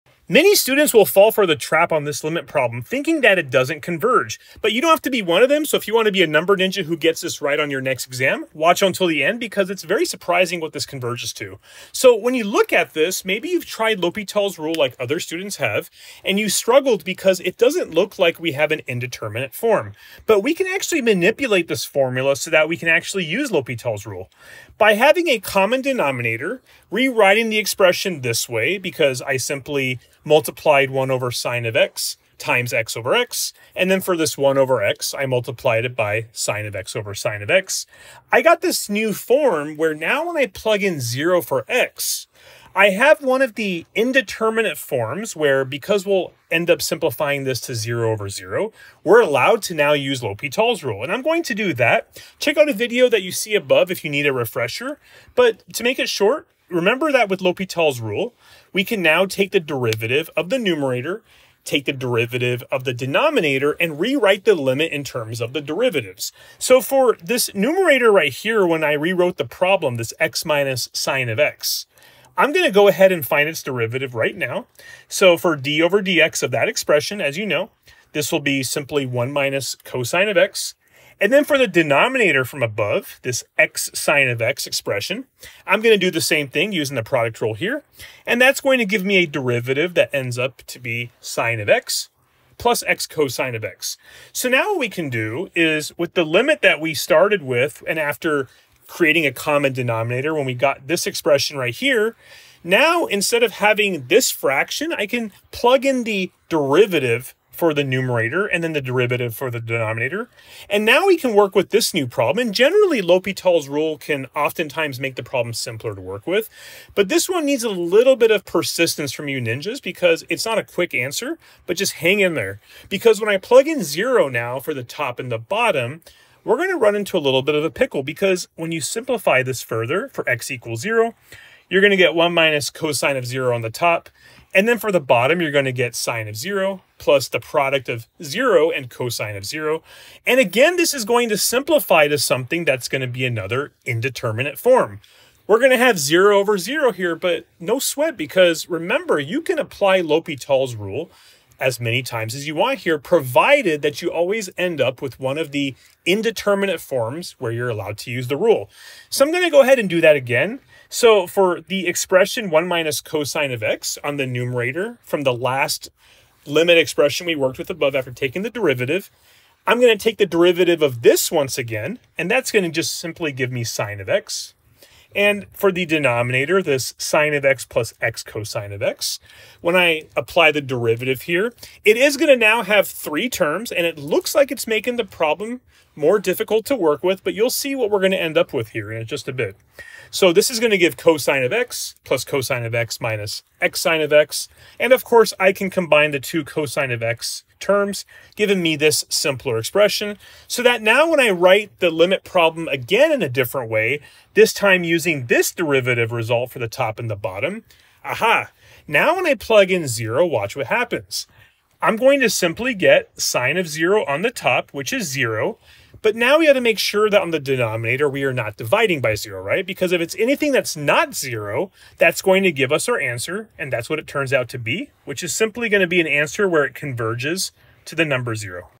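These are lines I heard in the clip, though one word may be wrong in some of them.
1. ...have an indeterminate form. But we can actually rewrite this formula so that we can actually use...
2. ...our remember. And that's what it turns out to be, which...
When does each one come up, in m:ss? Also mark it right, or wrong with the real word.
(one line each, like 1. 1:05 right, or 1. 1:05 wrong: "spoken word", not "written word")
1. 0:18 wrong: "manipulate", not "rewrite"
2. 3:42 wrong: "answer", not "remember".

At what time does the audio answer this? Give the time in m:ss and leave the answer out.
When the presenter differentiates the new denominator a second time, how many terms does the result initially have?
3:02.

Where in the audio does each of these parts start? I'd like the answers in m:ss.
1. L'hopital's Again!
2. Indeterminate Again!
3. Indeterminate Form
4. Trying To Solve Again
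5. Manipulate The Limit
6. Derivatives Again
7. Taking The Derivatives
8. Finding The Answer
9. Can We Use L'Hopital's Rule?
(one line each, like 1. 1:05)
1. 2:28
2. 2:04
3. 0:42
4. 1:38
5. 0:13
6. 2:48
7. 0:55
8. 3:19
9. 0:25.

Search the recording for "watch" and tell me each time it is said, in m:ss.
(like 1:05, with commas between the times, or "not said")
0:08, 3:30.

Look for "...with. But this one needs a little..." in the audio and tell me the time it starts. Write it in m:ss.
1:56.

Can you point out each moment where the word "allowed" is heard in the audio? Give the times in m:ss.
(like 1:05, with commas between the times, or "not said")
0:49, 2:37.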